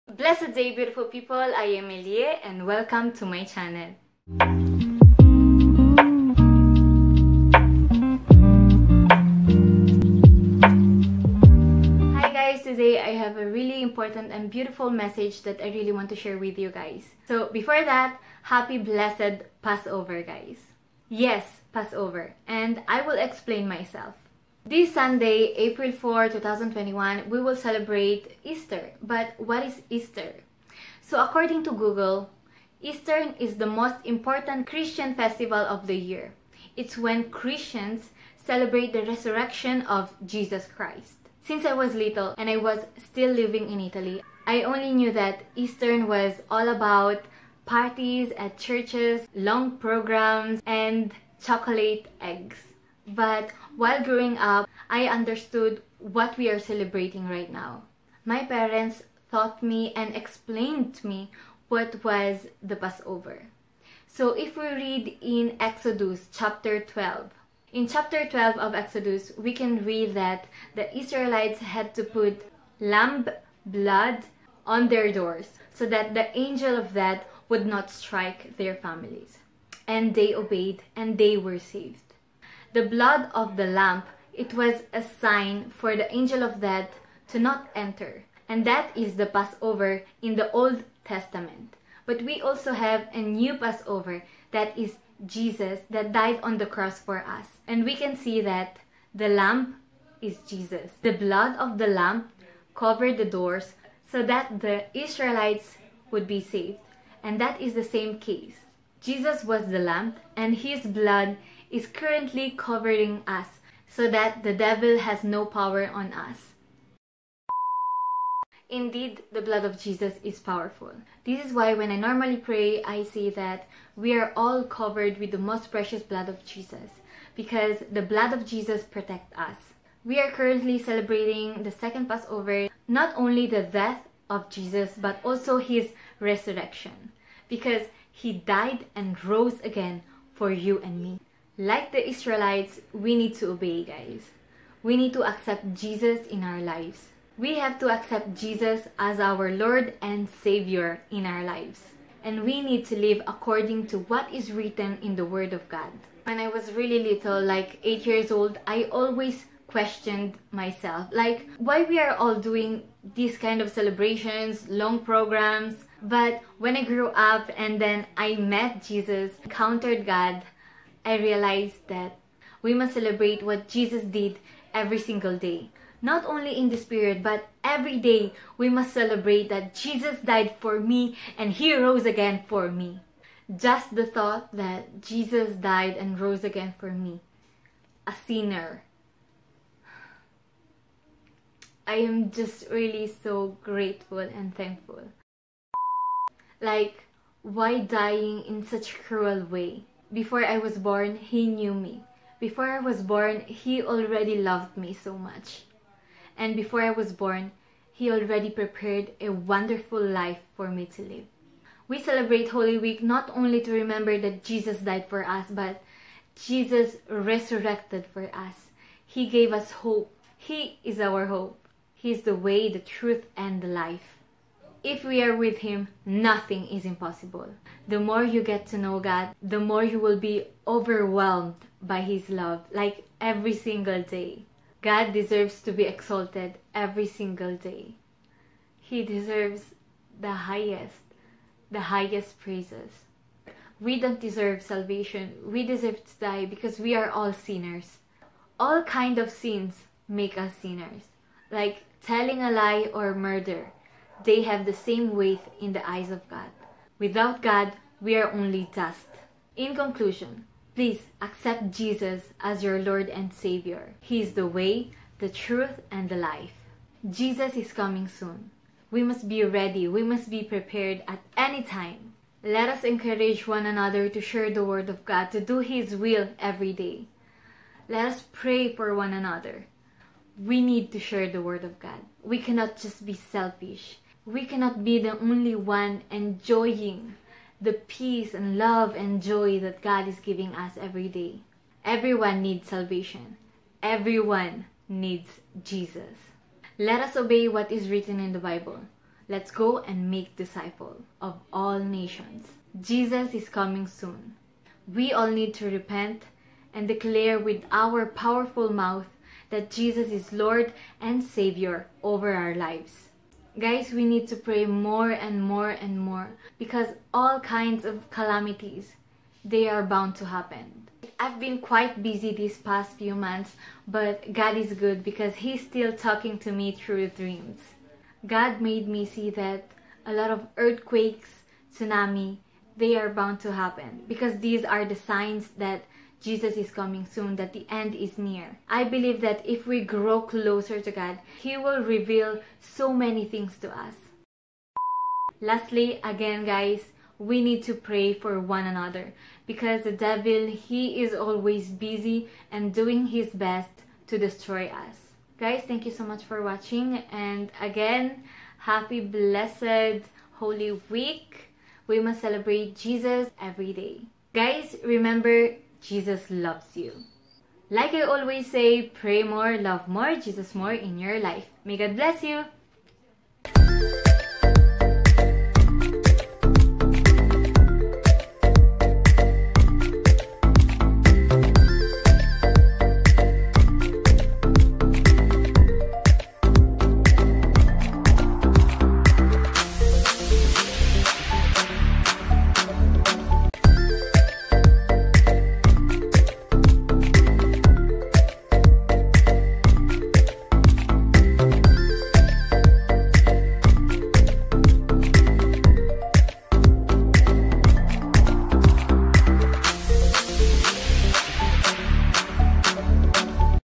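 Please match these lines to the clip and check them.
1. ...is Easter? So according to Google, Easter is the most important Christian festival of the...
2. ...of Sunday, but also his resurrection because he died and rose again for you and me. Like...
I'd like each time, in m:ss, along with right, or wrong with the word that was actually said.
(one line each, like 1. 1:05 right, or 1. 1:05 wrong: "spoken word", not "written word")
1. 0:29 right
2. 2:14 wrong: "Jesus", not "Sunday".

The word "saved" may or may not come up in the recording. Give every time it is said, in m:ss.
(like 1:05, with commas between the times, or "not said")
1:21, 1:46.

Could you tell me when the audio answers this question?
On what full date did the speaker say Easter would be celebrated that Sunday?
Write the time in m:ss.
0:25.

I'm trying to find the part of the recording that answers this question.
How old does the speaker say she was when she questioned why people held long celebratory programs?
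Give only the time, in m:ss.
2:37.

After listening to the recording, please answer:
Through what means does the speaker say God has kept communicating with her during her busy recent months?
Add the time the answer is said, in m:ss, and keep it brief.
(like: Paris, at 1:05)
dreams, at 5:27.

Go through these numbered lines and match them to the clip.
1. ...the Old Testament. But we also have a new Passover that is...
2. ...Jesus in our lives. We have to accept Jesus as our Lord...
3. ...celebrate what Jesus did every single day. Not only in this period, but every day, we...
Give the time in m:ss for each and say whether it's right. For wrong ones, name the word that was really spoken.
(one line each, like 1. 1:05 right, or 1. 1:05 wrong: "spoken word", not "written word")
1. 1:30 right
2. 2:25 right
3. 2:52 right.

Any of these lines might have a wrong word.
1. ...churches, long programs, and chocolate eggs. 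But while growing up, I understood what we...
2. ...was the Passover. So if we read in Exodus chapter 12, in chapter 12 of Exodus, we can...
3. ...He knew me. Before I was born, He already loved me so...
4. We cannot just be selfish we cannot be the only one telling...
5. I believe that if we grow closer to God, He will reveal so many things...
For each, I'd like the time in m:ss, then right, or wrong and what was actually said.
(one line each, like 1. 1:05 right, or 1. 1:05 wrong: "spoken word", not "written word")
1. 0:48 right
2. 1:02 right
3. 3:21 right
4. 4:42 wrong: "enjoying", not "telling"
5. 5:38 right.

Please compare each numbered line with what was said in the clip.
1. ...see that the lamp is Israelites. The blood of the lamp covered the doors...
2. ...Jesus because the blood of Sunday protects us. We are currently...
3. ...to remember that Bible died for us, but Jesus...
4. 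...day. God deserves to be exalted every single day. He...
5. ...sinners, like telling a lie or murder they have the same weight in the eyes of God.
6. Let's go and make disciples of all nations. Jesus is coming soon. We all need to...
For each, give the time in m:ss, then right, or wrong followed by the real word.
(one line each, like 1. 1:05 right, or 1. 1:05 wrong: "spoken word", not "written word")
1. 1:38 wrong: "Jesus", not "Israelites"
2. 2:06 wrong: "Jesus", not "Sunday"
3. 3:33 wrong: "Jesus", not "Bible"
4. 3:54 right
5. 4:10 right
6. 4:59 right.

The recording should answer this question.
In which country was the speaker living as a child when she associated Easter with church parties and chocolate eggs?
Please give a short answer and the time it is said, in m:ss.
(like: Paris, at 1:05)
Italy, at 0:43.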